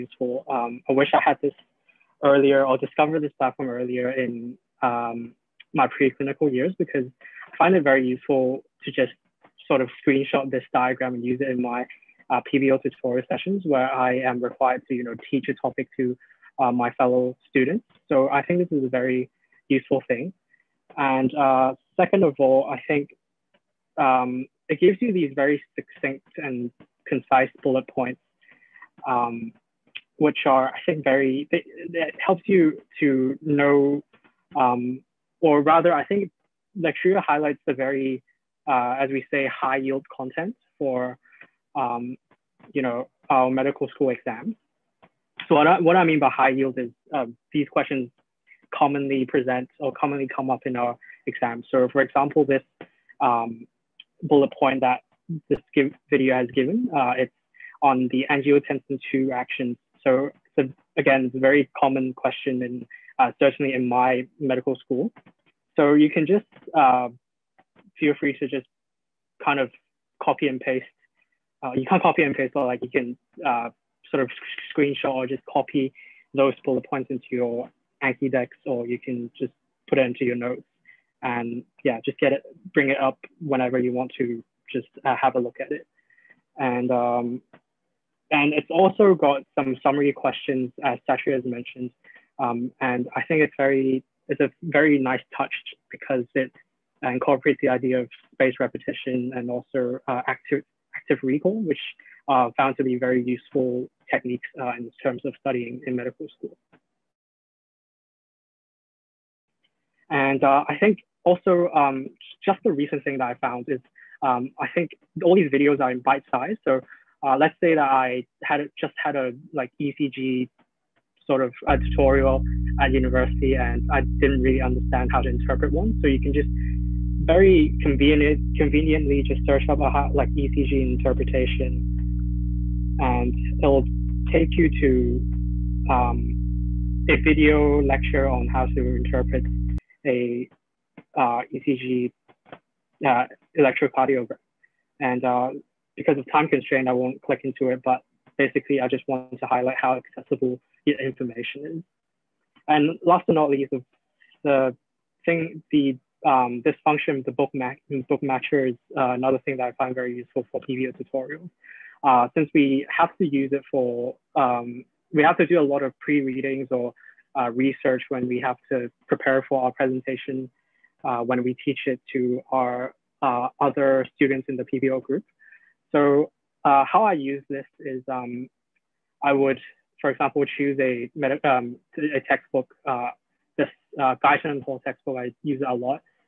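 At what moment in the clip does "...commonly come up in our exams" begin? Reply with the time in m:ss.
0:49.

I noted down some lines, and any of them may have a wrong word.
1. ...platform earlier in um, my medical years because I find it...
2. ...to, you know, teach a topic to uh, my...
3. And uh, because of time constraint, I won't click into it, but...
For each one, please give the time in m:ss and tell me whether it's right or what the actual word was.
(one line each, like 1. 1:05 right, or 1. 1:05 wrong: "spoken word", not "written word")
1. 0:03 wrong: "preclinical", not "medical"
2. 0:14 right
3. 2:24 right.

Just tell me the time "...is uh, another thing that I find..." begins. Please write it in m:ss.
2:38.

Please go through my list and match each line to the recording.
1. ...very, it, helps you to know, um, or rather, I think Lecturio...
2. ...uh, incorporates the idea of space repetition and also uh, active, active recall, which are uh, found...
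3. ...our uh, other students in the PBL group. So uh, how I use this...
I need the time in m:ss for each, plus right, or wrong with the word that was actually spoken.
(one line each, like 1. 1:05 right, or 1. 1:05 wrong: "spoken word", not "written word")
1. 0:31 right
2. 1:37 right
3. 2:52 right.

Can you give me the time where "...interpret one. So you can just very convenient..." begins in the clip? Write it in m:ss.
2:05.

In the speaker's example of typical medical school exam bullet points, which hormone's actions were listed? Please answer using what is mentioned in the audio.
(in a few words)
Angiotensin 2.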